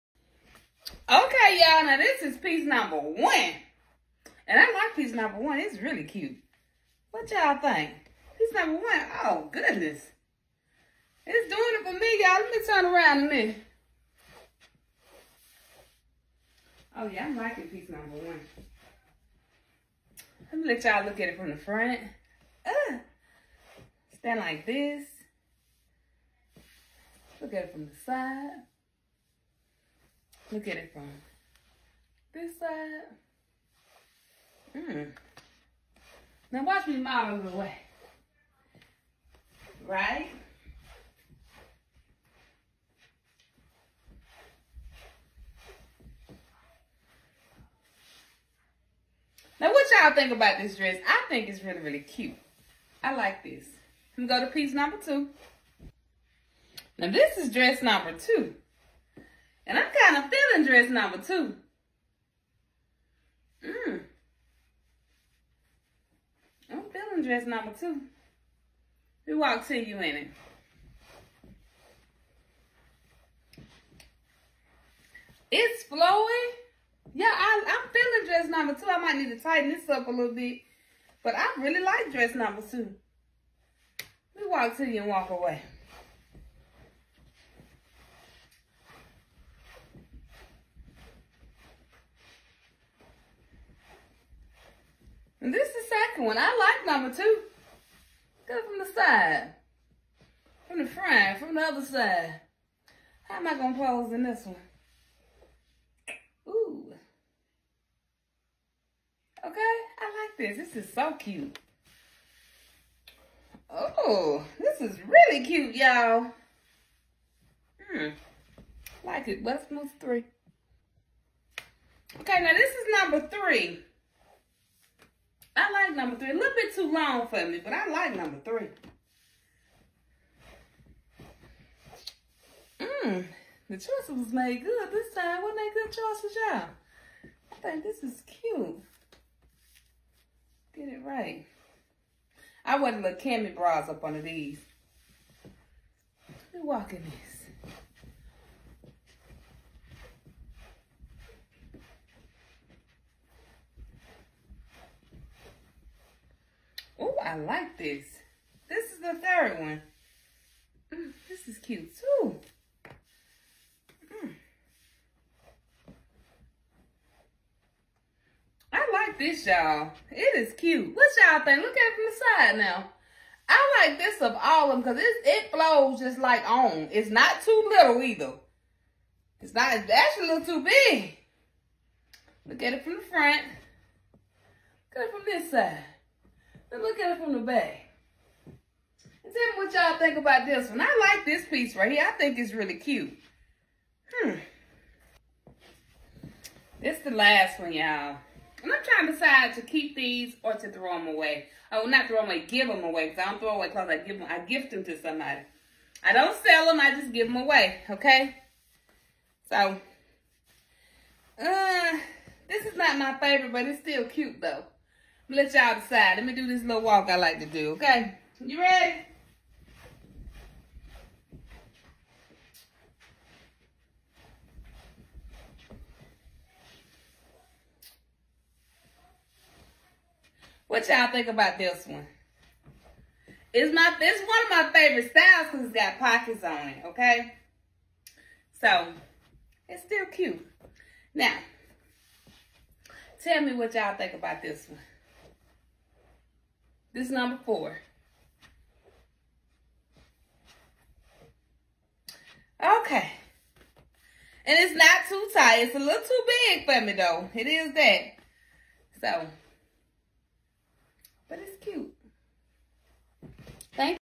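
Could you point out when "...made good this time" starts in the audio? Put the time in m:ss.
2:14.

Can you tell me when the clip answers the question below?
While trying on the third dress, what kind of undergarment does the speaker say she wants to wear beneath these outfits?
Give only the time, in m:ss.
2:23.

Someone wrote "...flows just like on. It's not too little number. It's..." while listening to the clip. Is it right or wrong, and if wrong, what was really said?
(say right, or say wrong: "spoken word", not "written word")
wrong: "either", not "number".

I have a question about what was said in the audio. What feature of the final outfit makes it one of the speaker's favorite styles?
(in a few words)
pockets.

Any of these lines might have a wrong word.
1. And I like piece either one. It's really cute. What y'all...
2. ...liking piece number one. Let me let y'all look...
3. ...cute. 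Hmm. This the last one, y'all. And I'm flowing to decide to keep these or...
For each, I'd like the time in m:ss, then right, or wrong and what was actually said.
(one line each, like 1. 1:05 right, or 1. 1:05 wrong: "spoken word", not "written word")
1. 0:04 wrong: "number", not "either"
2. 0:17 right
3. 3:12 wrong: "trying", not "flowing".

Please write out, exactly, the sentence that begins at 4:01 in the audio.
Now, tell me what y'all think about this one.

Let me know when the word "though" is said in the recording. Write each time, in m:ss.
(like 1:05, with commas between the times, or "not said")
3:34, 4:16.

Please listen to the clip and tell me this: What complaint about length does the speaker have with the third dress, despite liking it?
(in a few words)
a little bit too long.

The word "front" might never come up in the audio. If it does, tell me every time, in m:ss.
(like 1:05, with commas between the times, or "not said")
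0:21, 1:40, 3:03.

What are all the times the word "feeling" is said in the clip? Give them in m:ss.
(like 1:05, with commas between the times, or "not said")
1:00, 1:06, 1:17.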